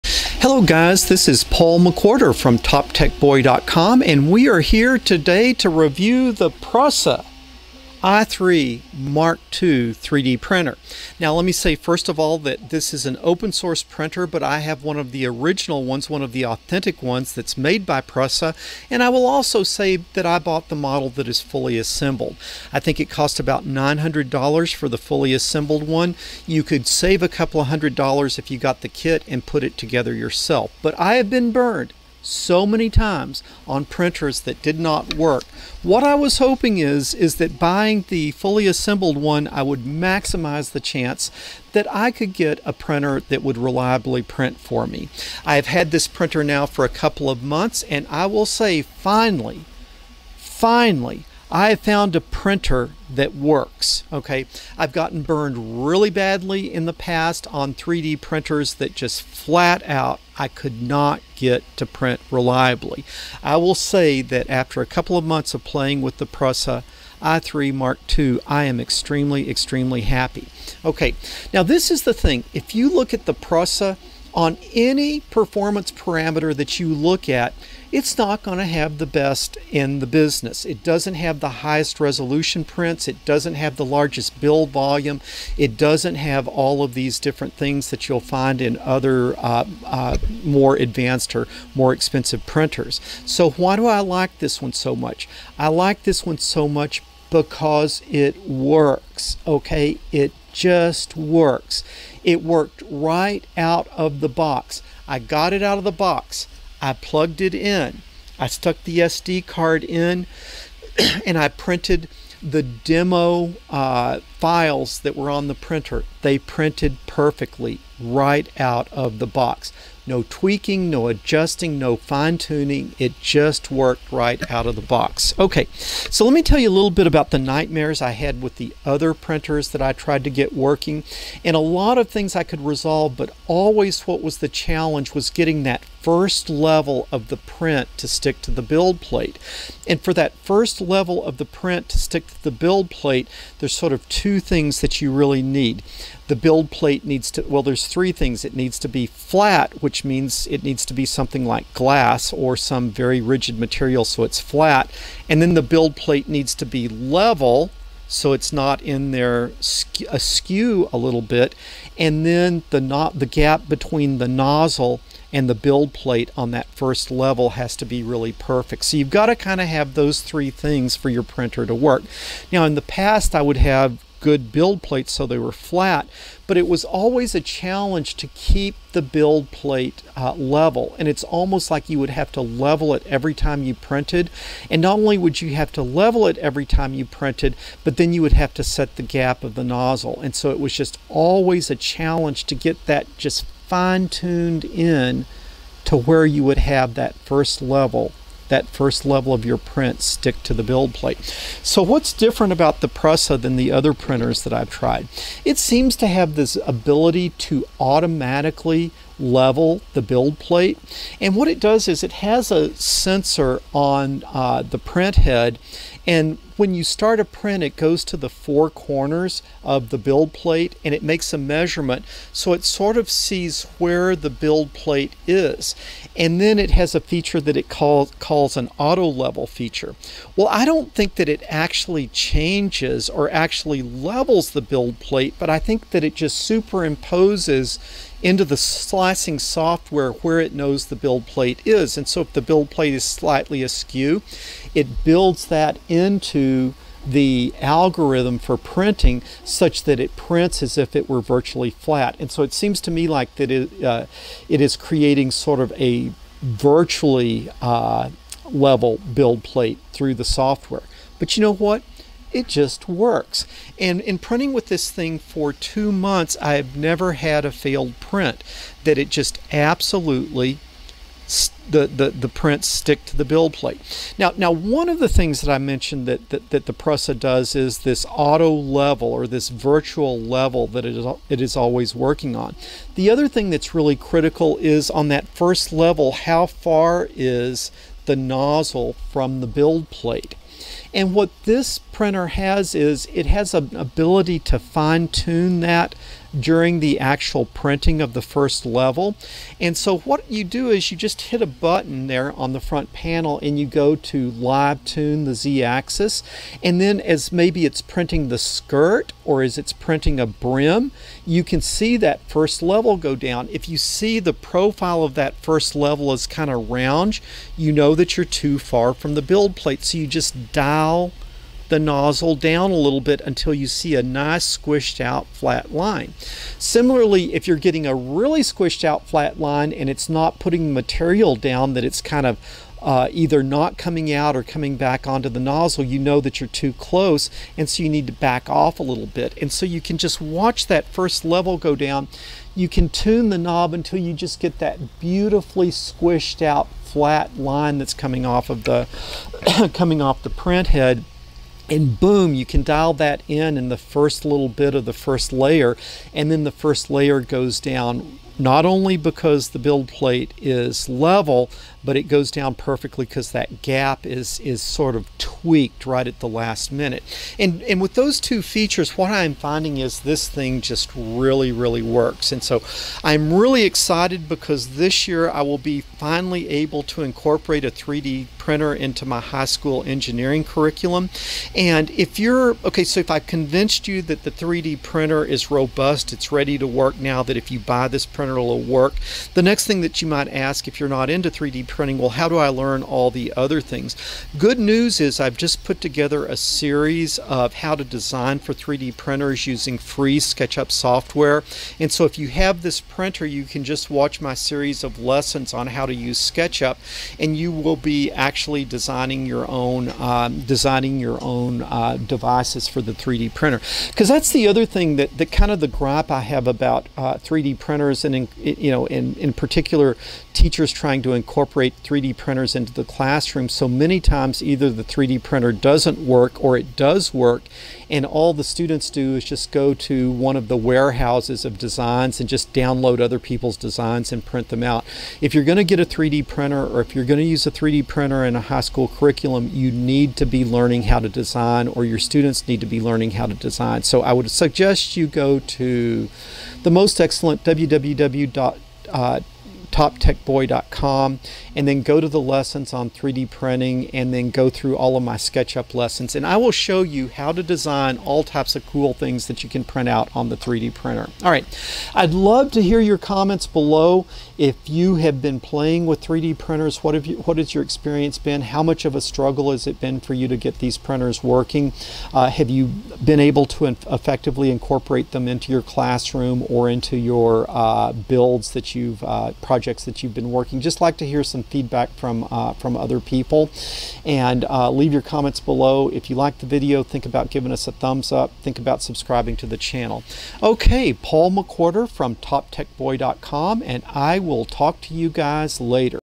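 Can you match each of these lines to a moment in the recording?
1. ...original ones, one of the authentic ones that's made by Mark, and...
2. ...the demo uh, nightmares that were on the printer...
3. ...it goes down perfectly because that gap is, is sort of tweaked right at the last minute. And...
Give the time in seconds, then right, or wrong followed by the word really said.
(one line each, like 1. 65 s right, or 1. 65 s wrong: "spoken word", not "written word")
1. 15 s wrong: "Prusa", not "Mark"
2. 112 s wrong: "files", not "nightmares"
3. 361 s right.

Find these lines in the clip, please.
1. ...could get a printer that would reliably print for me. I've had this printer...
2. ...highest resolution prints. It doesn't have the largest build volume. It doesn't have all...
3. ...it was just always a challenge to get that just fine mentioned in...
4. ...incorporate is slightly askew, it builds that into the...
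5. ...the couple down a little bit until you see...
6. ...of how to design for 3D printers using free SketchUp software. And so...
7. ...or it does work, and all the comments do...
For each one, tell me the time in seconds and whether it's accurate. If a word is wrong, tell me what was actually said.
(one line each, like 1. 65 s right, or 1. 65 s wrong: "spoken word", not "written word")
1. 42 s right
2. 81 s right
3. 190 s wrong: "tuned", not "mentioned"
4. 242 s wrong: "plate", not "incorporate"
5. 321 s wrong: "nozzle", not "couple"
6. 397 s right
7. 426 s wrong: "students", not "comments".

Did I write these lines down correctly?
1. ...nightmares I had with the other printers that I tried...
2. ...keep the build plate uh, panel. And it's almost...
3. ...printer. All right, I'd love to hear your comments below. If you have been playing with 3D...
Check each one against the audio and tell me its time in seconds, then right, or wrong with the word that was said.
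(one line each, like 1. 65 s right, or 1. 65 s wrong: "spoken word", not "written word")
1. 127 s right
2. 178 s wrong: "level", not "panel"
3. 460 s right.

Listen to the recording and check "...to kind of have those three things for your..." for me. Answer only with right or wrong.
right.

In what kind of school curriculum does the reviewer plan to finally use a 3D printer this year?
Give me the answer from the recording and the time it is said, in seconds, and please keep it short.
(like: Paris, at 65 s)
high school engineering, at 379 s.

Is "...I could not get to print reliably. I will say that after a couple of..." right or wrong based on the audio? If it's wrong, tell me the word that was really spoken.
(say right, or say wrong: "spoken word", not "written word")
right.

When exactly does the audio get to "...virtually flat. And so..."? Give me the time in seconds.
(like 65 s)
251 s.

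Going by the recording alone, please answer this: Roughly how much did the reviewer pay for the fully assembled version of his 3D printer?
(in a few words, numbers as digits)
$900.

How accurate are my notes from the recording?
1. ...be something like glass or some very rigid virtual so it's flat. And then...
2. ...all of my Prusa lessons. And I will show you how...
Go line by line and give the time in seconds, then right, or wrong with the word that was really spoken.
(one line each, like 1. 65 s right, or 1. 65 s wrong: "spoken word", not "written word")
1. 150 s wrong: "material", not "virtual"
2. 454 s wrong: "SketchUp", not "Prusa".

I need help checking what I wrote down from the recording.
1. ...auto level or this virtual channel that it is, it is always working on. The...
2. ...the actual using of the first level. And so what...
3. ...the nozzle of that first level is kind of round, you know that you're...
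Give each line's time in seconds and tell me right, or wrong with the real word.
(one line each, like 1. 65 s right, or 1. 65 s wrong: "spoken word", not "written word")
1. 278 s wrong: "level", not "channel"
2. 296 s wrong: "printing", not "using"
3. 314 s wrong: "profile", not "nozzle".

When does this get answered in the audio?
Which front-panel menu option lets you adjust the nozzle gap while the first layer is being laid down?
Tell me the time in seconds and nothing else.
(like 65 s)
304 s.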